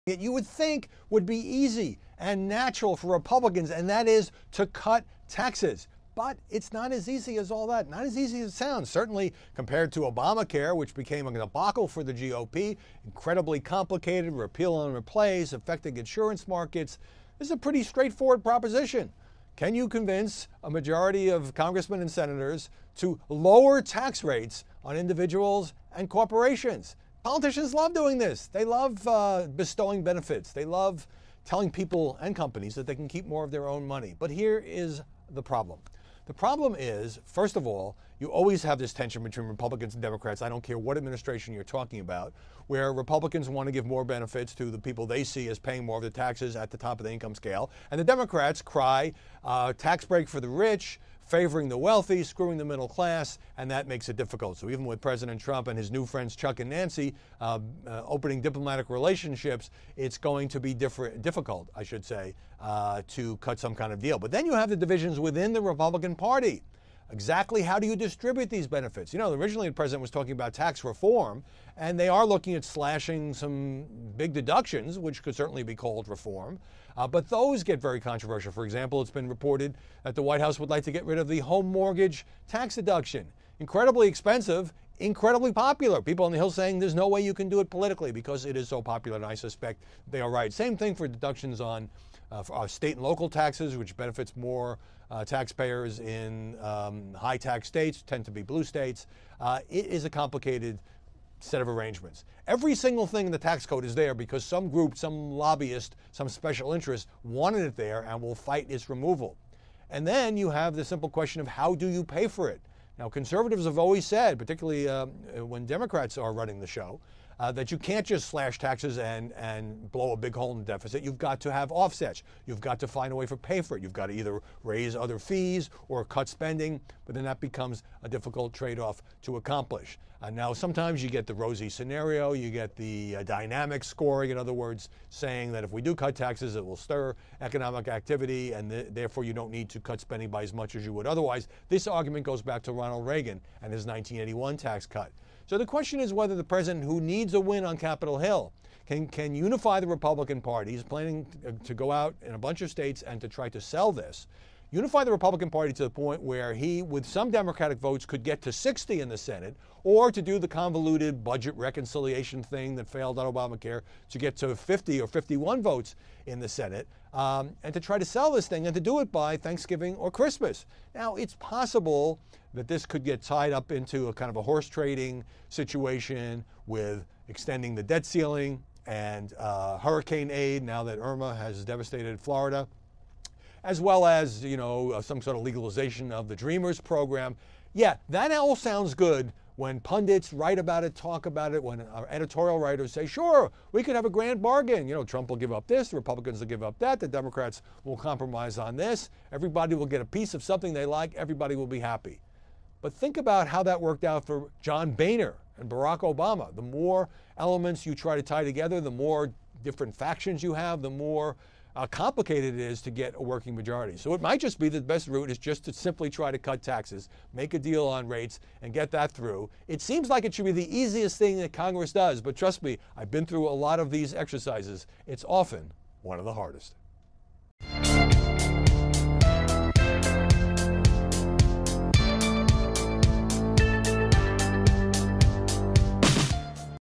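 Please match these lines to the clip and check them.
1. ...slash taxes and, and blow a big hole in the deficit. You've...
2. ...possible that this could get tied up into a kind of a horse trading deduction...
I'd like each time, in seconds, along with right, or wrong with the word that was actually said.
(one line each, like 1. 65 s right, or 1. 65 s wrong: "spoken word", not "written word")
1. 118 s right
2. 171 s wrong: "situation", not "deduction".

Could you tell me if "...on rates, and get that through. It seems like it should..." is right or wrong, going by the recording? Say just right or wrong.
right.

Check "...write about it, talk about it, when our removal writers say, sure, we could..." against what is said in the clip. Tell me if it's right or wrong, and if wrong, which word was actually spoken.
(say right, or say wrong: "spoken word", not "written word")
wrong: "editorial", not "removal".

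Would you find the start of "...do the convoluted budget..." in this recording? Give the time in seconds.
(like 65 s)
160 s.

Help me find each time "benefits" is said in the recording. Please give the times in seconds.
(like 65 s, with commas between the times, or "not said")
30 s, 44 s, 68 s, 93 s.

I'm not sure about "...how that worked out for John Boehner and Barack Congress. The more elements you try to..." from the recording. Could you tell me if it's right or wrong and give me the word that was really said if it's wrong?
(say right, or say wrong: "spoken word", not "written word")
wrong: "Obama", not "Congress".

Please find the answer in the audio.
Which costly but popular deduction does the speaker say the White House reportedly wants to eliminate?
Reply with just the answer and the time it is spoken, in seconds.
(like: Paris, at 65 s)
home mortgage tax deduction, at 81 s.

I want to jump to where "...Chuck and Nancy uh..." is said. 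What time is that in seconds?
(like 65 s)
56 s.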